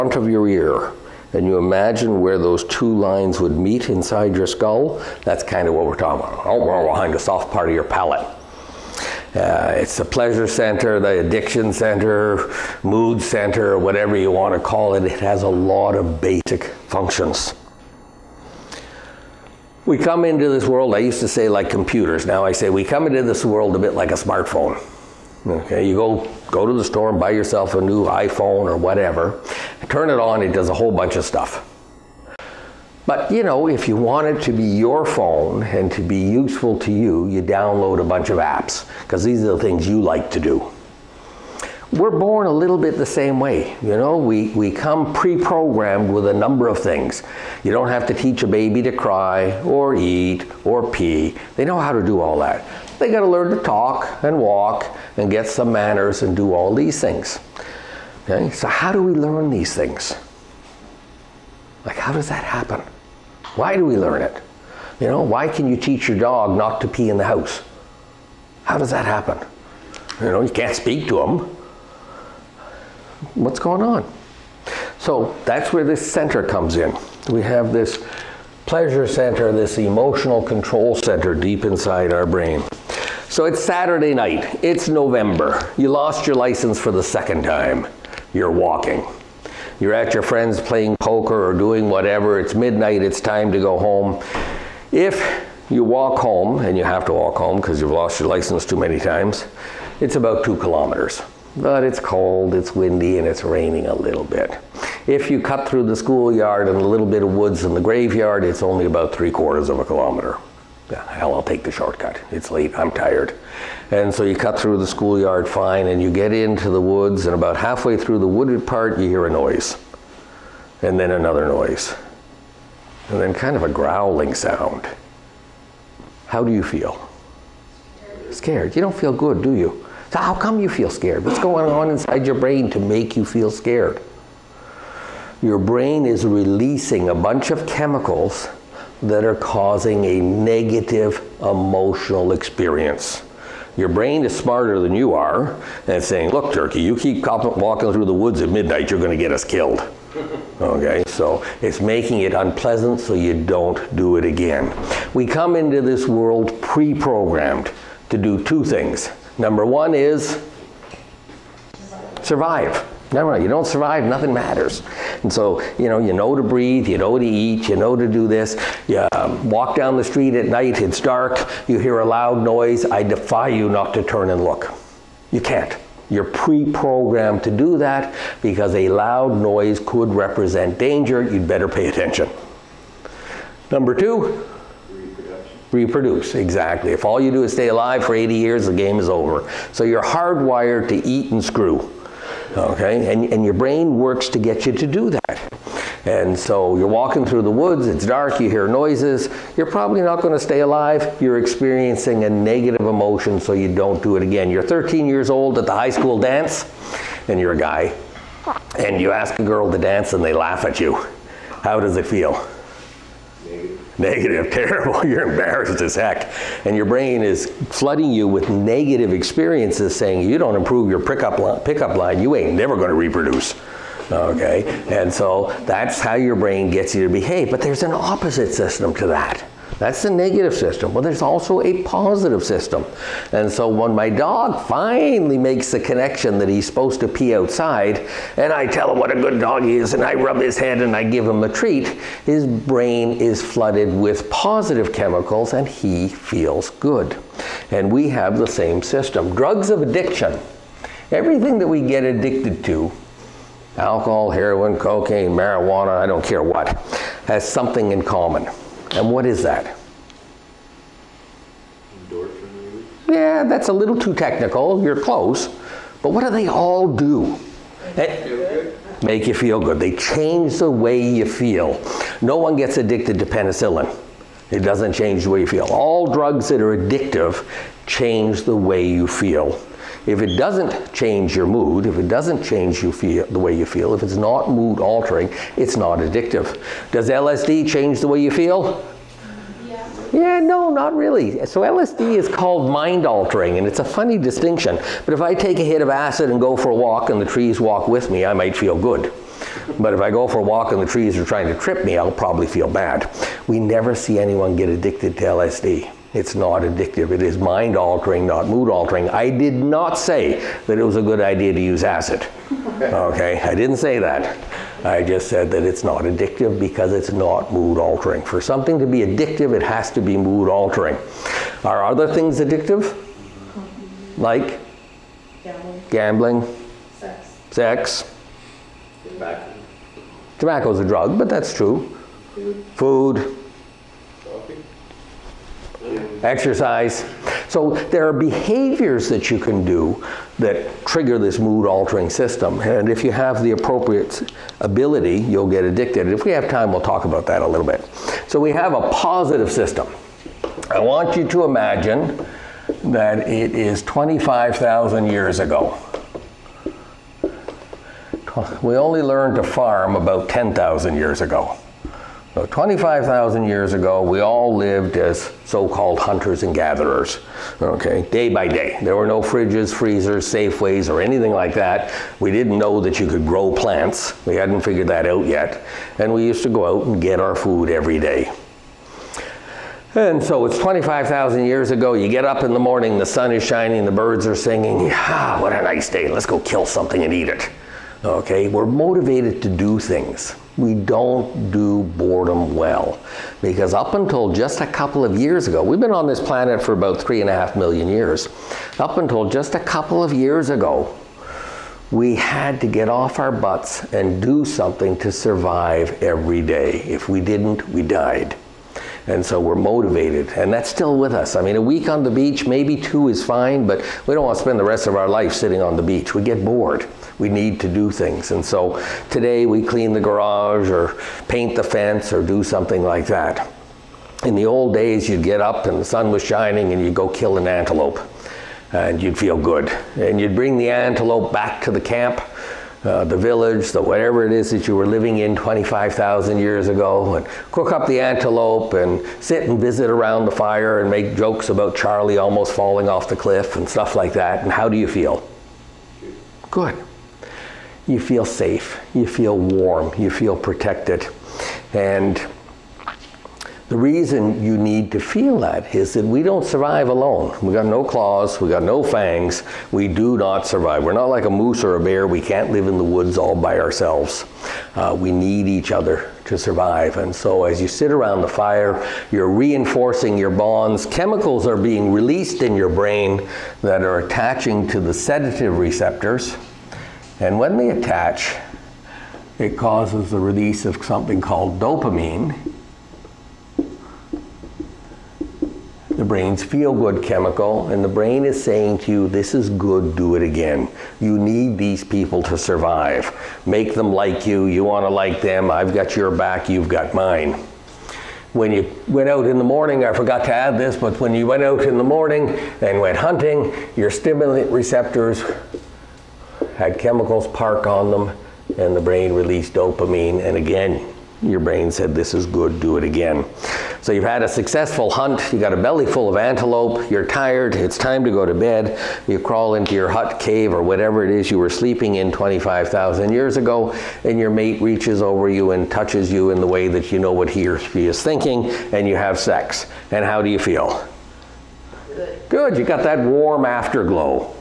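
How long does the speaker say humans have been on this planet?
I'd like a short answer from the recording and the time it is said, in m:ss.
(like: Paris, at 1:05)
3.5 million years, at 6:37.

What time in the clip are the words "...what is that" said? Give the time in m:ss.
4:19.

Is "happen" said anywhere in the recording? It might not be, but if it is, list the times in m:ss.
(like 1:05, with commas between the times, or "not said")
1:02, 1:09.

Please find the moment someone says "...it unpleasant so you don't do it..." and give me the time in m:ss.
2:32.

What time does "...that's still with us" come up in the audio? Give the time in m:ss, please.
6:50.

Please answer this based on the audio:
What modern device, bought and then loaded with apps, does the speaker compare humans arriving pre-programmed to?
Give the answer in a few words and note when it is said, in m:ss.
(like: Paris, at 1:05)
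smartphone, at 0:24.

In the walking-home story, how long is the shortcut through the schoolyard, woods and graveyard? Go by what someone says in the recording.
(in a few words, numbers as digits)
three quarters of a kilometer.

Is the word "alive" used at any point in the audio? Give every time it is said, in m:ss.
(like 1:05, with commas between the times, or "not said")
3:07, 3:20.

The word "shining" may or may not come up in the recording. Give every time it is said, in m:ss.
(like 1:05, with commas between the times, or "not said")
6:23, 7:06.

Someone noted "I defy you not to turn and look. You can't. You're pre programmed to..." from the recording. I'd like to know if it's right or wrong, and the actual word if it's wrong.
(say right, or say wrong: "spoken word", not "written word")
right.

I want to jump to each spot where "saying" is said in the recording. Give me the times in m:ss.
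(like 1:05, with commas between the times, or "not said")
2:26, 3:39, 8:08.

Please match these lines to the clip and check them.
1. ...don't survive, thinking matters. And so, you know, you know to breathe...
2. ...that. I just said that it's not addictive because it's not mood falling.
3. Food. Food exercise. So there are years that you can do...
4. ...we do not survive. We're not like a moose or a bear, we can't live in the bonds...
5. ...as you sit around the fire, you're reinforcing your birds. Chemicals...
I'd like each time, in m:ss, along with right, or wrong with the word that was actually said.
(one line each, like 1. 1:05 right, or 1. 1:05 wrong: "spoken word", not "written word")
1. 2:43 wrong: "nothing", not "thinking"
2. 5:13 wrong: "altering", not "falling"
3. 5:32 wrong: "behaviors", not "years"
4. 7:39 wrong: "woods", not "bonds"
5. 7:47 wrong: "bonds", not "birds".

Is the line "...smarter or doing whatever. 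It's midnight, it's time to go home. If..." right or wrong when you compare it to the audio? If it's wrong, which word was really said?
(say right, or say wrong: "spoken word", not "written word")
wrong: "poker", not "smarter".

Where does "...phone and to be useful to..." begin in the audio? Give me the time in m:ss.
0:35.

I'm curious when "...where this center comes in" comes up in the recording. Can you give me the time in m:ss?
1:15.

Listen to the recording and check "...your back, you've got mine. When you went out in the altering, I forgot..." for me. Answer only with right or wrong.
wrong.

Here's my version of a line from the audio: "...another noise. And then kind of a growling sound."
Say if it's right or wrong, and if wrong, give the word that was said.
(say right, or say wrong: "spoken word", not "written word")
right.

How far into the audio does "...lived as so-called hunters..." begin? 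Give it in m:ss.
6:04.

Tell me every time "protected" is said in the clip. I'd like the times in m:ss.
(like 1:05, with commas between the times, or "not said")
7:30.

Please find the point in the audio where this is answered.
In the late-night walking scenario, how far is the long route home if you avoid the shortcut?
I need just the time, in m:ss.
1:40.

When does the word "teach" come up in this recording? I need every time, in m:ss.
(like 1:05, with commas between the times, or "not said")
0:48, 1:05.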